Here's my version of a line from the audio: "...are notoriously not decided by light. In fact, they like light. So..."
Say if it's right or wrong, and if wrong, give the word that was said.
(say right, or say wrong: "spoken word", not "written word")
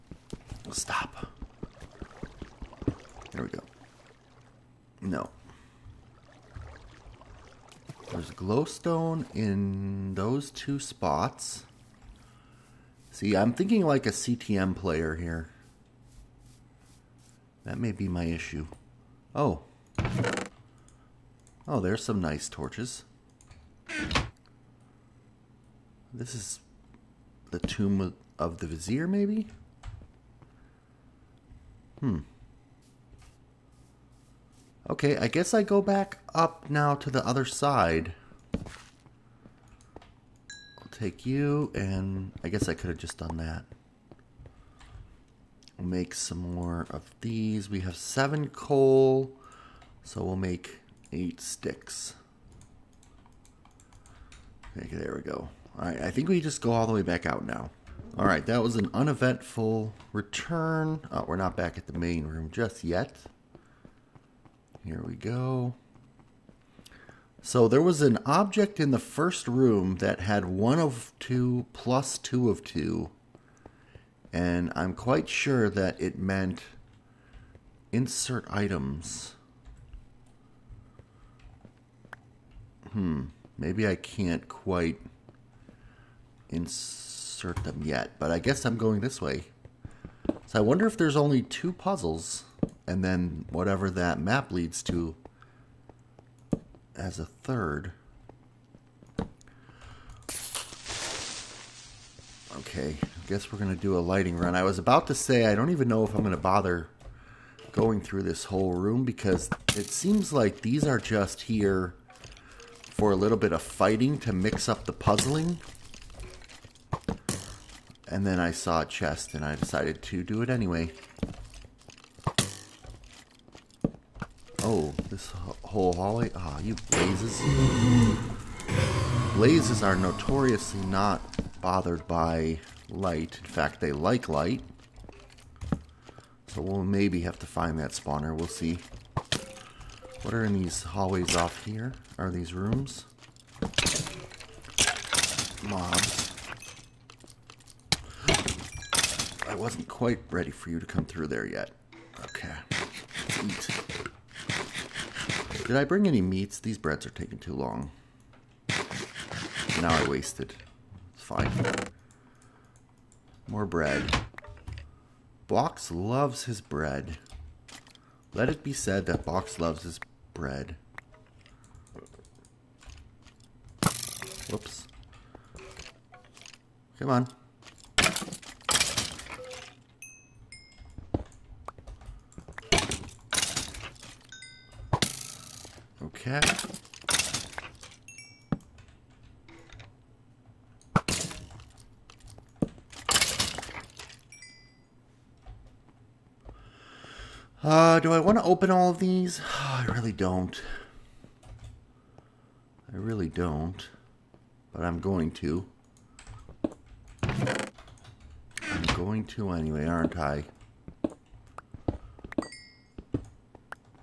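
wrong: "bothered", not "decided".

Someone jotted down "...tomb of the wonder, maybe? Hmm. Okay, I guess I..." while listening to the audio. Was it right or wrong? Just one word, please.
wrong.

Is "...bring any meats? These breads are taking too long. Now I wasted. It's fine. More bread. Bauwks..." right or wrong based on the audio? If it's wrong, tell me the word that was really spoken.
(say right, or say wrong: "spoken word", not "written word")
right.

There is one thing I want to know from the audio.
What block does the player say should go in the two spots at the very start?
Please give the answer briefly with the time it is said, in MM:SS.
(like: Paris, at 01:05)
glowstone, at 00:08.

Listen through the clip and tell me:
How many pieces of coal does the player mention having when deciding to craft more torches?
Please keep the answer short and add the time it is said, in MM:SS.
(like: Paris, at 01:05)
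7, at 00:47.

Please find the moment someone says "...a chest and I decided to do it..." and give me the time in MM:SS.
01:58.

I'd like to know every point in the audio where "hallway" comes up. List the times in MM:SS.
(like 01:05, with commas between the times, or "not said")
02:05, 02:20.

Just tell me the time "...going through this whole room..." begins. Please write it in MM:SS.
01:47.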